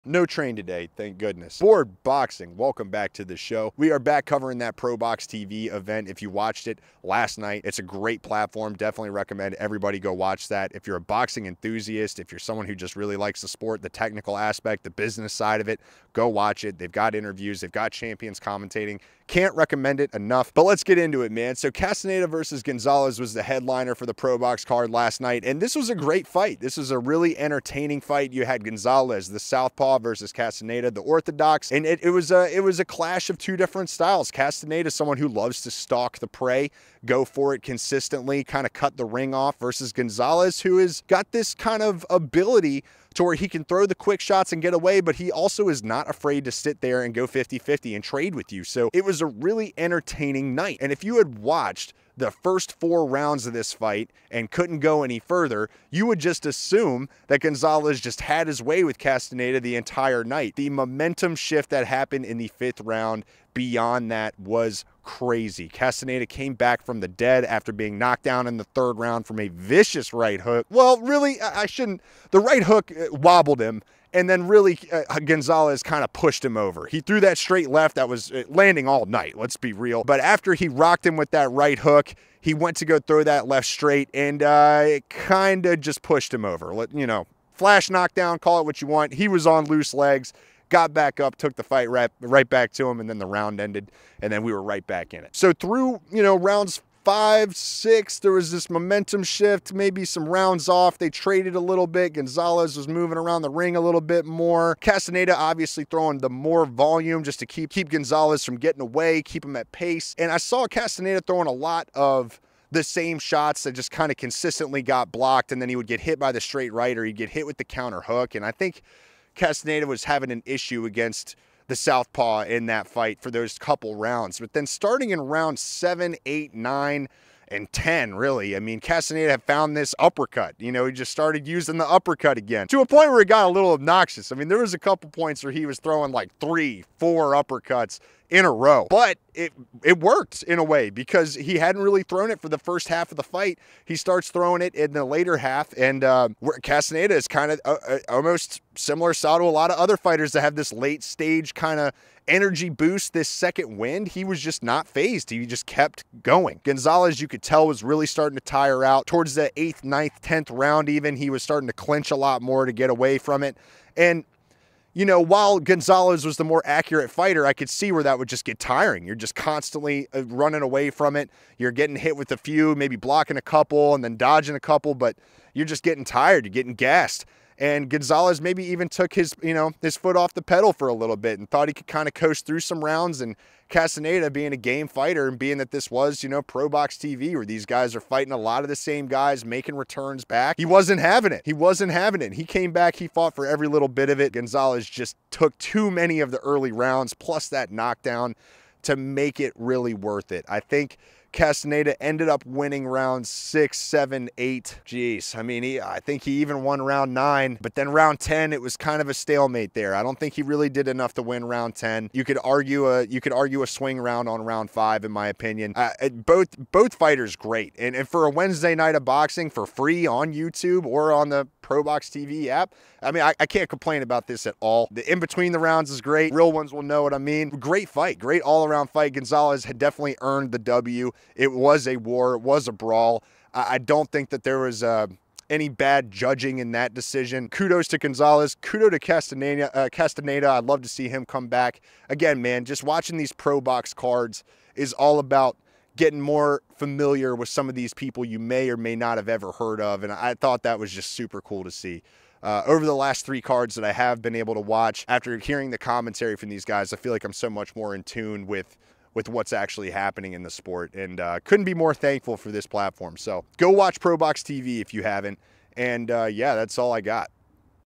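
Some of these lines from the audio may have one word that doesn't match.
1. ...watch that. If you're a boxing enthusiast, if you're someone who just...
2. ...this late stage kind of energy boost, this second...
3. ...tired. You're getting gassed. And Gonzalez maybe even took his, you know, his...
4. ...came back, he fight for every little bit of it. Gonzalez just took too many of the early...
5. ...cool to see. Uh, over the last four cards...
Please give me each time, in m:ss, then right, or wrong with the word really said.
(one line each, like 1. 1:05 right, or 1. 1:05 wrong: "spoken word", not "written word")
1. 0:10 right
2. 2:30 right
3. 2:56 right
4. 3:12 wrong: "fought", not "fight"
5. 4:11 wrong: "three", not "four".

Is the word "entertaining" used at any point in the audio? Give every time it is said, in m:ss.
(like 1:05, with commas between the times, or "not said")
0:27, 0:49.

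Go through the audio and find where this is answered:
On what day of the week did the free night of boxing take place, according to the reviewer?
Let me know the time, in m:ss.
3:38.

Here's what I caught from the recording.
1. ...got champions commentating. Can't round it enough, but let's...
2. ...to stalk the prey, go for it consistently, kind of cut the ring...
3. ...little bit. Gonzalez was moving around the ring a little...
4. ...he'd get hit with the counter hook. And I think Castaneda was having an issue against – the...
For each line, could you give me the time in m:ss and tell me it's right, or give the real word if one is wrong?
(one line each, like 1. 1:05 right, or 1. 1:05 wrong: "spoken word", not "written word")
1. 0:17 wrong: "recommend", not "round"
2. 0:35 right
3. 1:41 right
4. 1:57 right.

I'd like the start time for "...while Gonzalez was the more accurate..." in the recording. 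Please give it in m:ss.
2:45.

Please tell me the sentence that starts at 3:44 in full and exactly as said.
The in between the rounds is great.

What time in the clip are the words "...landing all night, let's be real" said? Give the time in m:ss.
1:18.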